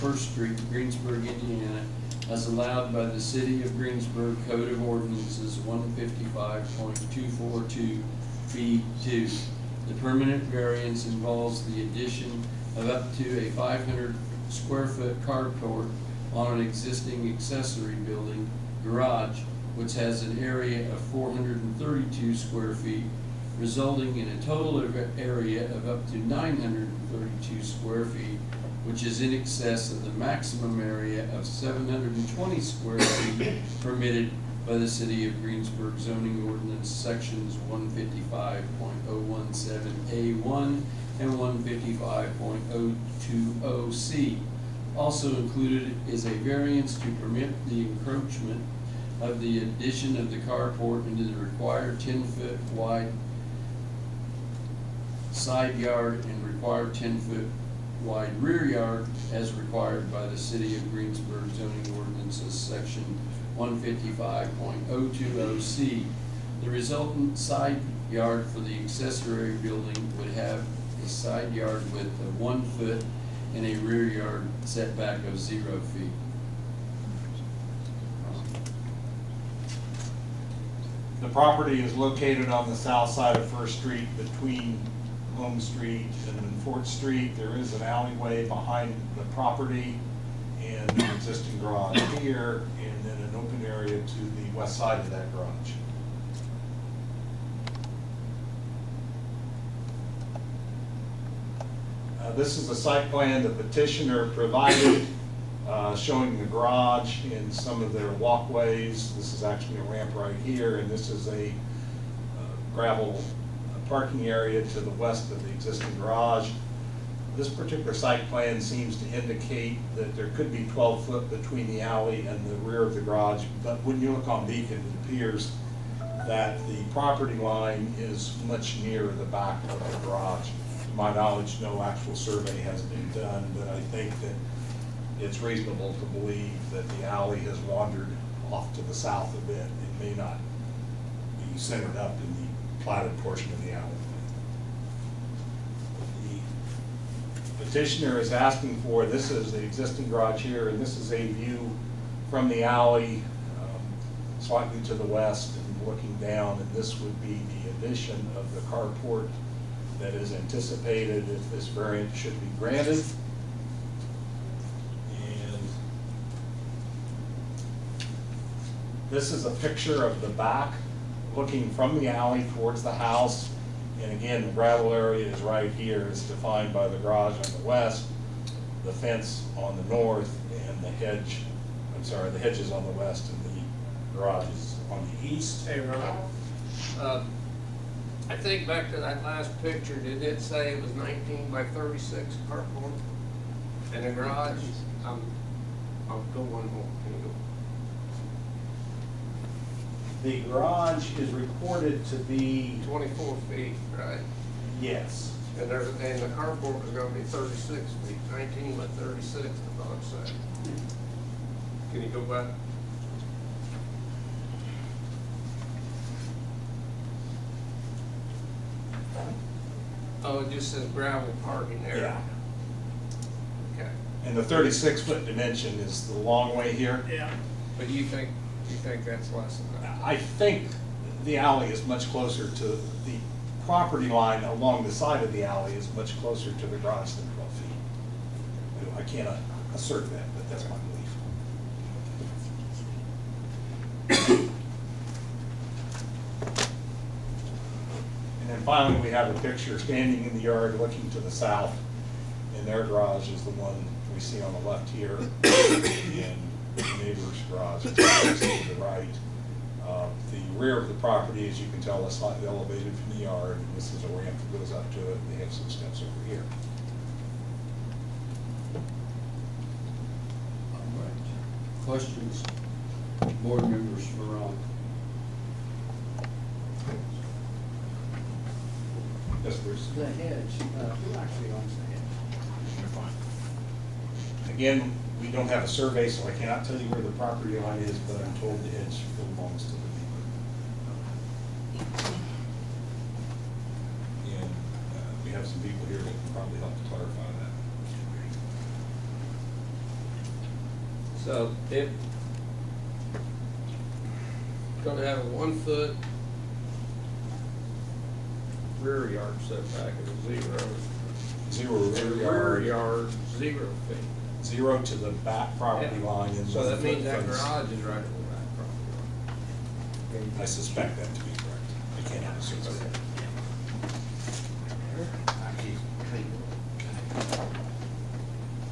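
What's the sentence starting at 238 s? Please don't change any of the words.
I can't assert that, but that's my belief.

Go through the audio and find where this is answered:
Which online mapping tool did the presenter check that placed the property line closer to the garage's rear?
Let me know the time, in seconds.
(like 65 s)
124 s.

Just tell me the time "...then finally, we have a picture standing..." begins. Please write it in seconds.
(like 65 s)
248 s.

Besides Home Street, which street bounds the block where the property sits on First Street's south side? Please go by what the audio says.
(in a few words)
Fort Street.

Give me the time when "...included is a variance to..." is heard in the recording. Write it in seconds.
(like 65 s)
45 s.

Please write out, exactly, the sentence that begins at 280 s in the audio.
Uh, who actually owns the hedge?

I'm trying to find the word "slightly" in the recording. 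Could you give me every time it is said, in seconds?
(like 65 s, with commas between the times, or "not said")
154 s, 262 s.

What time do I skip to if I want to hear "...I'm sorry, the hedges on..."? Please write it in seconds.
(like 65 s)
181 s.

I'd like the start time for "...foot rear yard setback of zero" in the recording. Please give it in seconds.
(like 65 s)
305 s.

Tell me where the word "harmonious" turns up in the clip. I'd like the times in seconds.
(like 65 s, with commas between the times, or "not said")
not said.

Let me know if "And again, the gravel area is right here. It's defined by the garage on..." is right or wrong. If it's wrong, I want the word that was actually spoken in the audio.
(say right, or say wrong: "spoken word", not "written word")
right.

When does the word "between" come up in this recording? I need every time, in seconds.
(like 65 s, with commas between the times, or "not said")
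84 s, 121 s.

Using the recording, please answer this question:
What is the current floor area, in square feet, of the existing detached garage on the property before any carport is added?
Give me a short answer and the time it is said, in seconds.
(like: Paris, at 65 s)
432 square feet, at 21 s.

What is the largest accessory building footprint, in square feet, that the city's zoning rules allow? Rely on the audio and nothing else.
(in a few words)
720 square feet.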